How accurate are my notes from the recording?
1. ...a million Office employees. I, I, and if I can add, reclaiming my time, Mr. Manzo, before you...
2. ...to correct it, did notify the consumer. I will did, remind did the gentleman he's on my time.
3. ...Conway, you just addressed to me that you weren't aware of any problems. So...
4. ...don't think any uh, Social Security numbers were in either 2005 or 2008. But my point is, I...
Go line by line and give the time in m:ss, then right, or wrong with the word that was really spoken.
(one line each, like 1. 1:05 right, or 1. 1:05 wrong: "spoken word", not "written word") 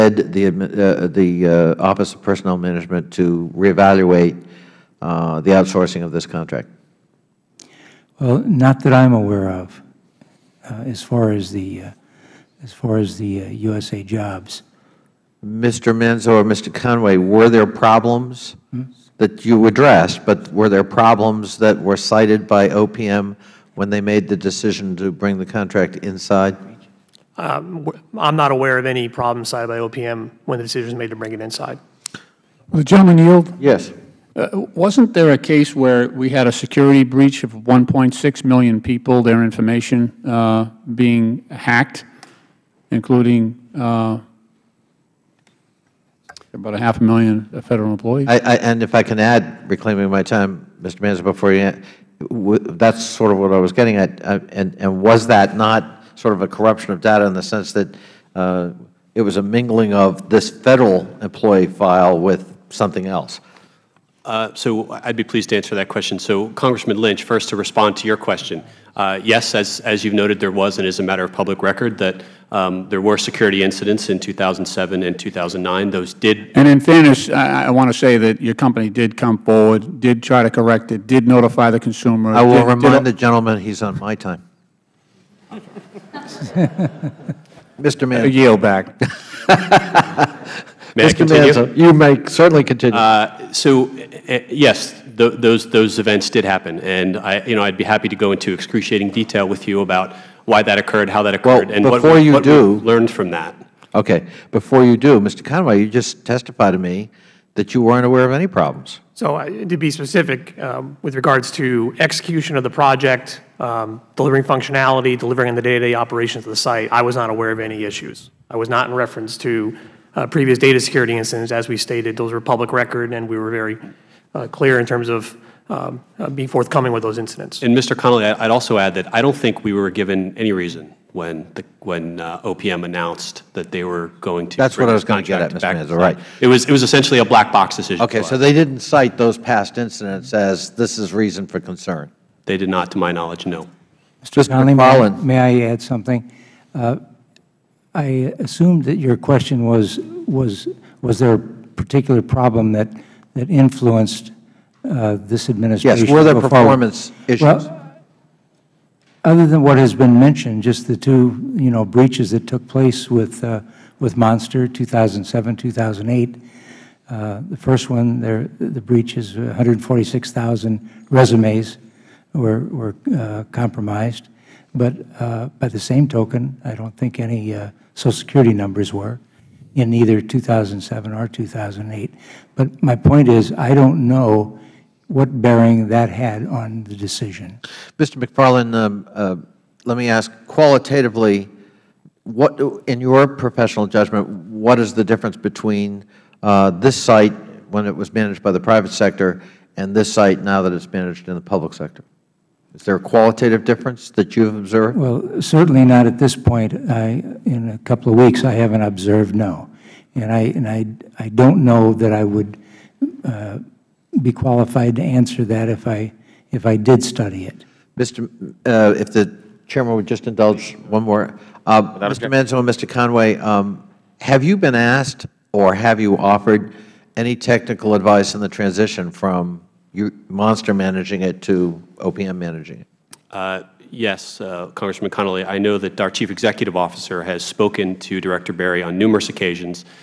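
1. 0:47 wrong: "Federal", not "Office"
2. 1:20 right
3. 1:45 wrong: "testified", not "addressed"
4. 2:56 wrong: "2007", not "2005".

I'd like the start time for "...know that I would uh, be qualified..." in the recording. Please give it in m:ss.
3:31.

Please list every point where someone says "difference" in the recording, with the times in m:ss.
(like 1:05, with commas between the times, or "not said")
3:15, 3:23.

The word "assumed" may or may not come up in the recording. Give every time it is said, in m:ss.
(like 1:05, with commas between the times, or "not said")
2:28.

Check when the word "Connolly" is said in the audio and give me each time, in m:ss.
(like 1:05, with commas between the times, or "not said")
2:07, 2:24, 3:55.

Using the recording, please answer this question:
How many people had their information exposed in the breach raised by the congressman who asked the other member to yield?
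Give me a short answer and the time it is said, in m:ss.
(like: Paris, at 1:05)
1.6 million, at 0:37.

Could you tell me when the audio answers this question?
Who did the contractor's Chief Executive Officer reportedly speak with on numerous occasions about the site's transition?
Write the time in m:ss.
3:58.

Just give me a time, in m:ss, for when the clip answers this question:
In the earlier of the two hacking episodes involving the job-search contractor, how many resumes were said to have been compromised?
2:49.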